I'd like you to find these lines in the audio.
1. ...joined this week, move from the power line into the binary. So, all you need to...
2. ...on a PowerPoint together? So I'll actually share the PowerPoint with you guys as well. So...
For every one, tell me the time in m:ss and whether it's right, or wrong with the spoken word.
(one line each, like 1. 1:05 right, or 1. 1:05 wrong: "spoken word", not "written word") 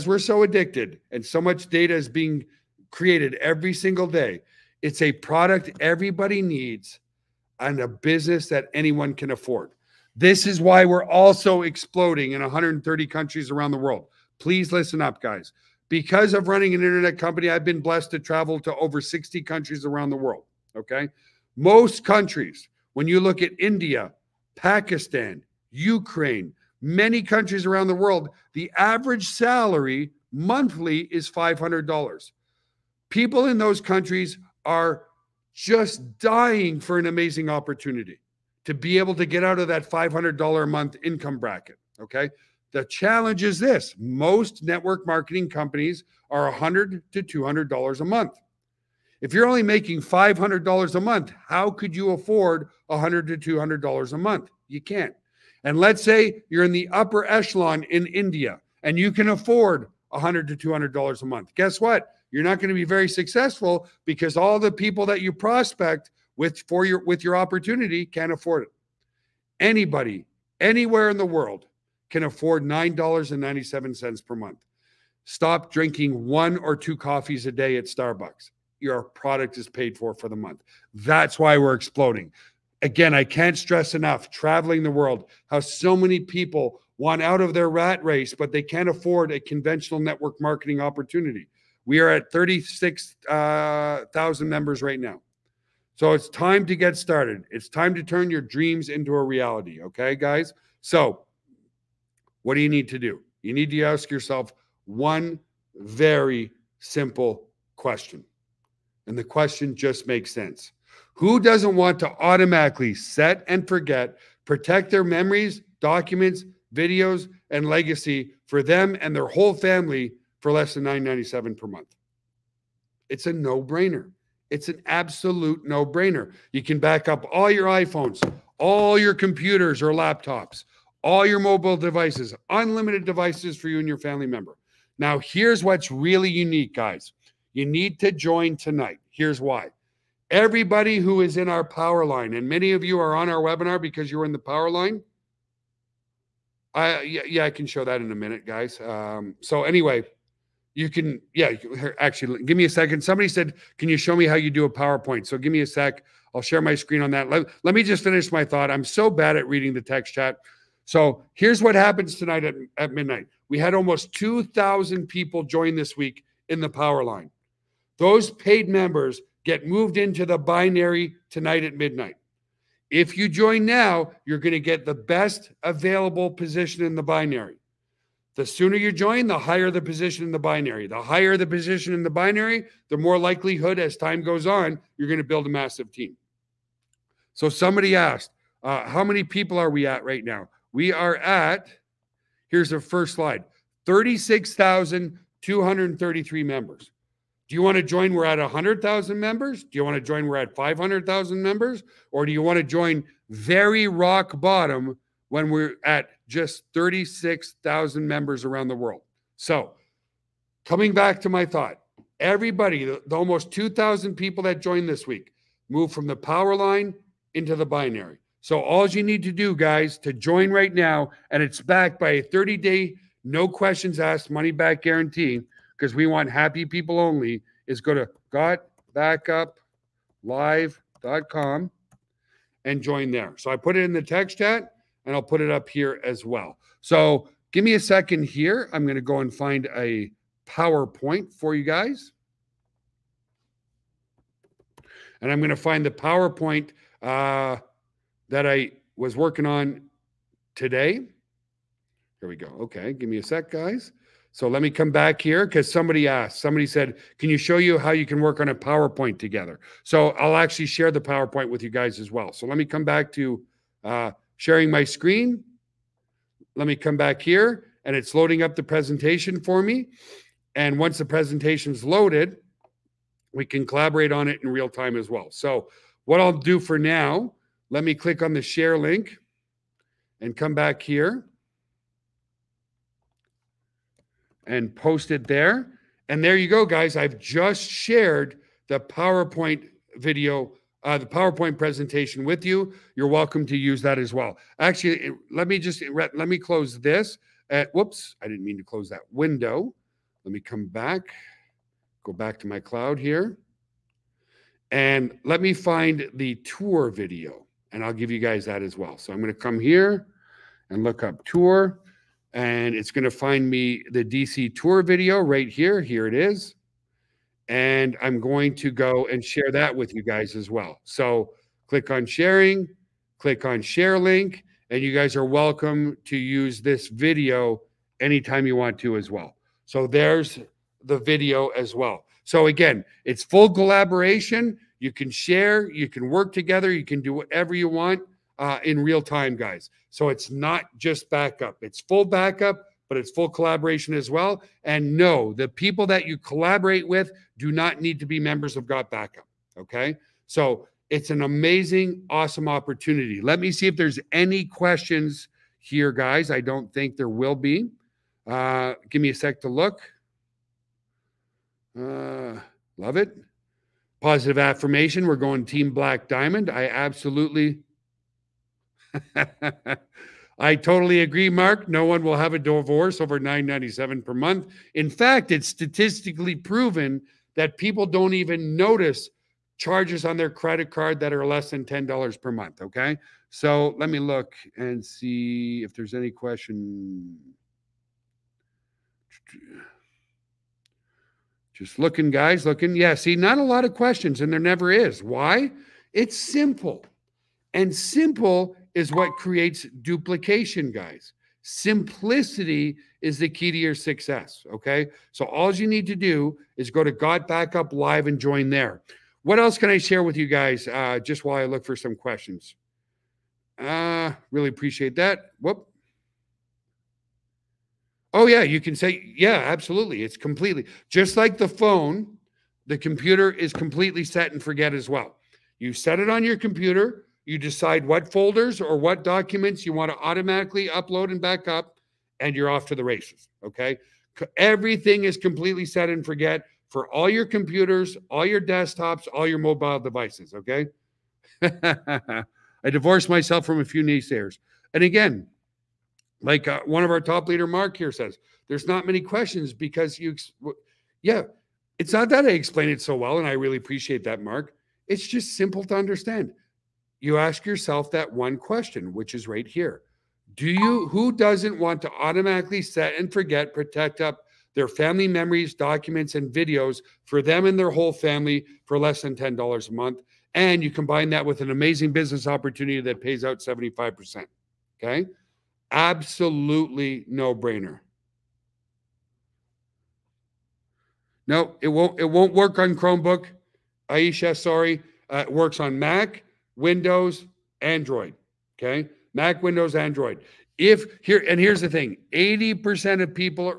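1. 3:34 right
2. 4:18 right.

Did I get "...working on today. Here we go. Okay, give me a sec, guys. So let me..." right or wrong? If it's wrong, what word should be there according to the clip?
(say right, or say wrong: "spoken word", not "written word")
right.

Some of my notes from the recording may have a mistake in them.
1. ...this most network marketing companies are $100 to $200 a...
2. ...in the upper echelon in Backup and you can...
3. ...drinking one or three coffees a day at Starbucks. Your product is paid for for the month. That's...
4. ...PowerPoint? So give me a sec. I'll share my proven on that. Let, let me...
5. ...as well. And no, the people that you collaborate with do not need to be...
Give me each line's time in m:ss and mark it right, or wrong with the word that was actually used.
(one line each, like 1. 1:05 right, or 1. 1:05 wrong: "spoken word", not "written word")
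1. 0:43 right
2. 0:56 wrong: "India", not "Backup"
3. 1:15 wrong: "two", not "three"
4. 2:34 wrong: "screen", not "proven"
5. 5:43 right.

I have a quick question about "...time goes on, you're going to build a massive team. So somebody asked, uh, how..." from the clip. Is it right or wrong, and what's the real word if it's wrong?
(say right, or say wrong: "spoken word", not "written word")
right.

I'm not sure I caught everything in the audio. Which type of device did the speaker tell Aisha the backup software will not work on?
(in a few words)
Chromebook.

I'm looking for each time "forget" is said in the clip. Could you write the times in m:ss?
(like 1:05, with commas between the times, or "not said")
1:53, 7:04, 7:16, 7:43.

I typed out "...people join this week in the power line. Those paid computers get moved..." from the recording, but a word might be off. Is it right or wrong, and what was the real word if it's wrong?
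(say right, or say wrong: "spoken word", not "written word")
wrong: "members", not "computers".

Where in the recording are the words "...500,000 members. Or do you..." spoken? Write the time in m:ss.
3:20.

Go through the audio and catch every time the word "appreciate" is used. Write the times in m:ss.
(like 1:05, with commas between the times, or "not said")
6:54, 7:33.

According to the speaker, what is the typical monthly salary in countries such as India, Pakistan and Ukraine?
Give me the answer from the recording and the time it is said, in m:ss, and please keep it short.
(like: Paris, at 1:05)
$500, at 0:30.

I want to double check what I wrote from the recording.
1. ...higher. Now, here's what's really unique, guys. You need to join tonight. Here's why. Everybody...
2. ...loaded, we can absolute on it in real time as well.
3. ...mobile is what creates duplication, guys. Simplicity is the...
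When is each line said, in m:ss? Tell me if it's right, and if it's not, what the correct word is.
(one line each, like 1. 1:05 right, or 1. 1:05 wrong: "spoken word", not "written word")
1. 2:14 wrong: "member", not "higher"
2. 4:31 wrong: "collaborate", not "absolute"
3. 6:37 wrong: "simple", not "mobile".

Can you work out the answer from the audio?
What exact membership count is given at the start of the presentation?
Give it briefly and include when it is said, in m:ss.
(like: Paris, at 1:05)
36,233, at 3:13.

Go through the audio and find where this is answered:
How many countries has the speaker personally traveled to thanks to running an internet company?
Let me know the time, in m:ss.
0:18.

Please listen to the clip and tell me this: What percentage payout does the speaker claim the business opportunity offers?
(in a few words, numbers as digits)
75%.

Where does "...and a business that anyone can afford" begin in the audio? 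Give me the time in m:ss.
0:07.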